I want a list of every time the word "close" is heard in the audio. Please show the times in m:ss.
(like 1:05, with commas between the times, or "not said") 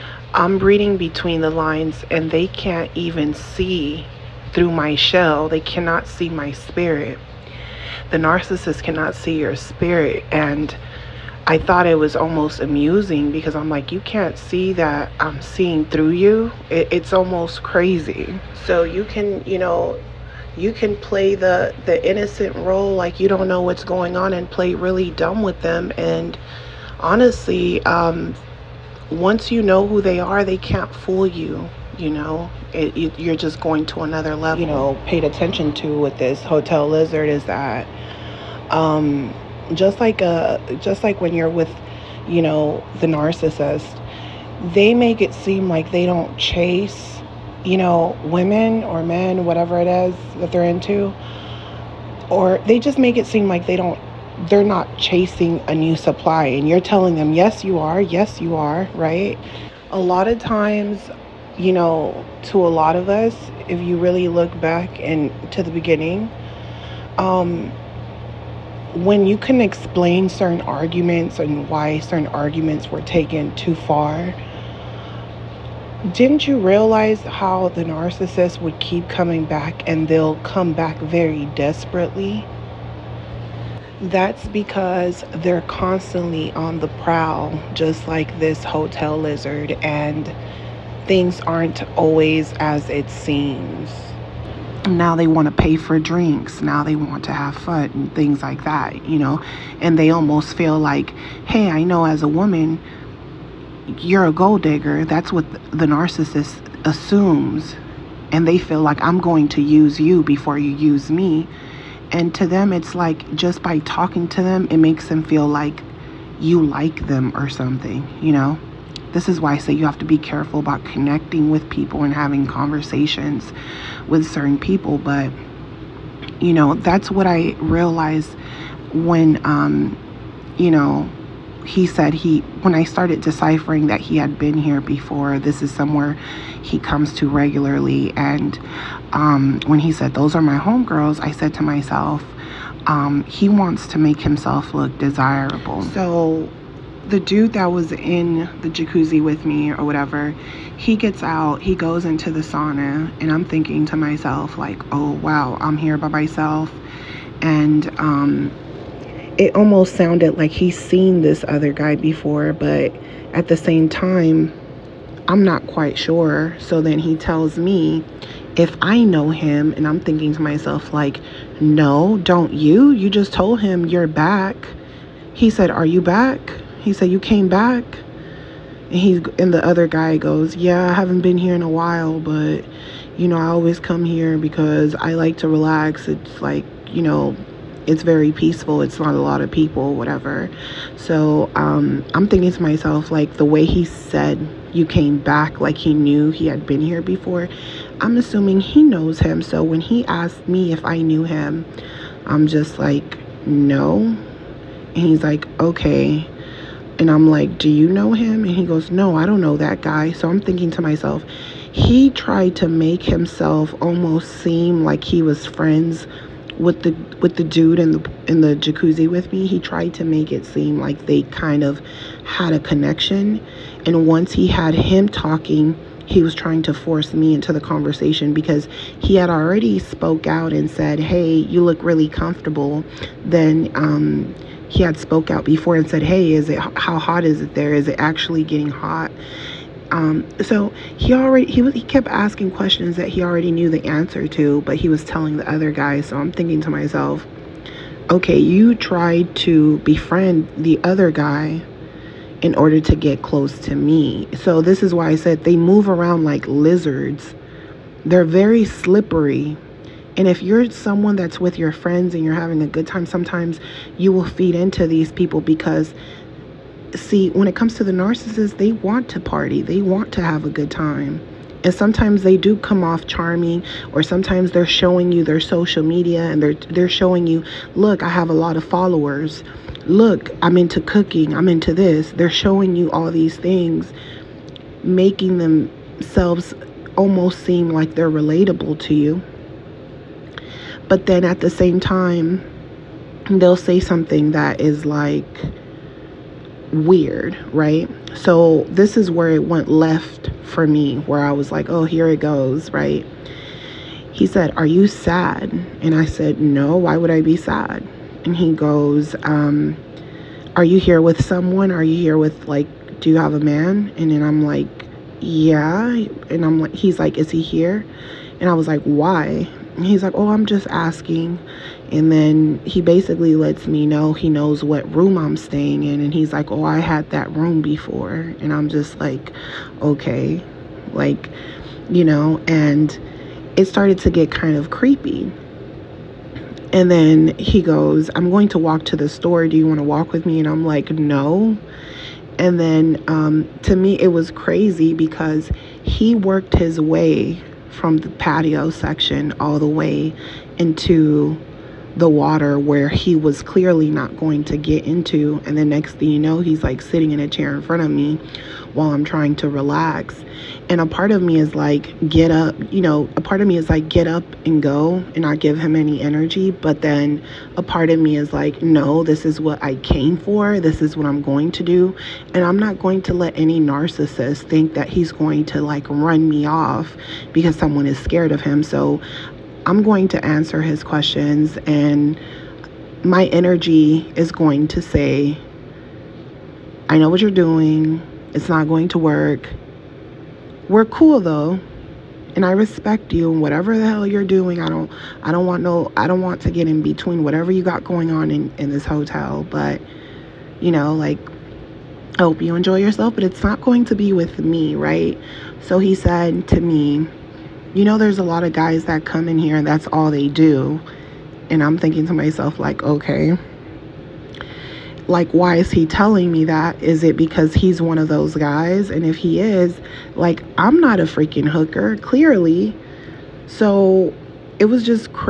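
4:13.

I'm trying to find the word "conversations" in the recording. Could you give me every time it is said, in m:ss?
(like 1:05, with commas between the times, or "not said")
2:02, 3:47.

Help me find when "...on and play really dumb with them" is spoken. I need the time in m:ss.
0:24.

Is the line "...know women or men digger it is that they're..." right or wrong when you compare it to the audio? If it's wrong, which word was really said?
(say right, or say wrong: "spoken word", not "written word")
wrong: "whatever", not "digger".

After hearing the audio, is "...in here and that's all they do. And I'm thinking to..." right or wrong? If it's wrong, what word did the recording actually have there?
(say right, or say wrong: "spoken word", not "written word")
right.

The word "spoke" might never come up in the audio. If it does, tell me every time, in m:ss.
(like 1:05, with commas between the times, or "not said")
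3:49, 3:54.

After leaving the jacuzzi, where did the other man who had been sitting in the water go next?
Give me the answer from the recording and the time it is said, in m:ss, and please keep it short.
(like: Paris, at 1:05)
the sauna, at 2:32.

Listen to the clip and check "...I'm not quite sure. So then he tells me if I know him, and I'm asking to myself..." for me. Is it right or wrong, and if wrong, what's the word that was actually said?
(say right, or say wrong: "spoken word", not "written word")
wrong: "thinking", not "asking".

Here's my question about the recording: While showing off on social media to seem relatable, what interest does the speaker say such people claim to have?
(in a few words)
cooking.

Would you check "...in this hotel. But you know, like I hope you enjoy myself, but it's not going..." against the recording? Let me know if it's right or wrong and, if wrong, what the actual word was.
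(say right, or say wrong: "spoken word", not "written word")
wrong: "yourself", not "myself".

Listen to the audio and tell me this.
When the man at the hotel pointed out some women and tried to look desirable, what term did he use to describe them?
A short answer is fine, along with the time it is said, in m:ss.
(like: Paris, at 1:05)
homegirls, at 2:20.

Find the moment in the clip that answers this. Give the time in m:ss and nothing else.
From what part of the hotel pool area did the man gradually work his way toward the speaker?
5:48.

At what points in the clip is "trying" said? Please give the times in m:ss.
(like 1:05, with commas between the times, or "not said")
3:46, 5:59.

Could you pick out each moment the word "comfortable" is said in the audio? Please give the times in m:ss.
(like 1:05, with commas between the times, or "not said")
3:52.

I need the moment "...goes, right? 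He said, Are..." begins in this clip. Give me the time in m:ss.
5:02.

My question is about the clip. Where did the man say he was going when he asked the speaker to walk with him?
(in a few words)
the store.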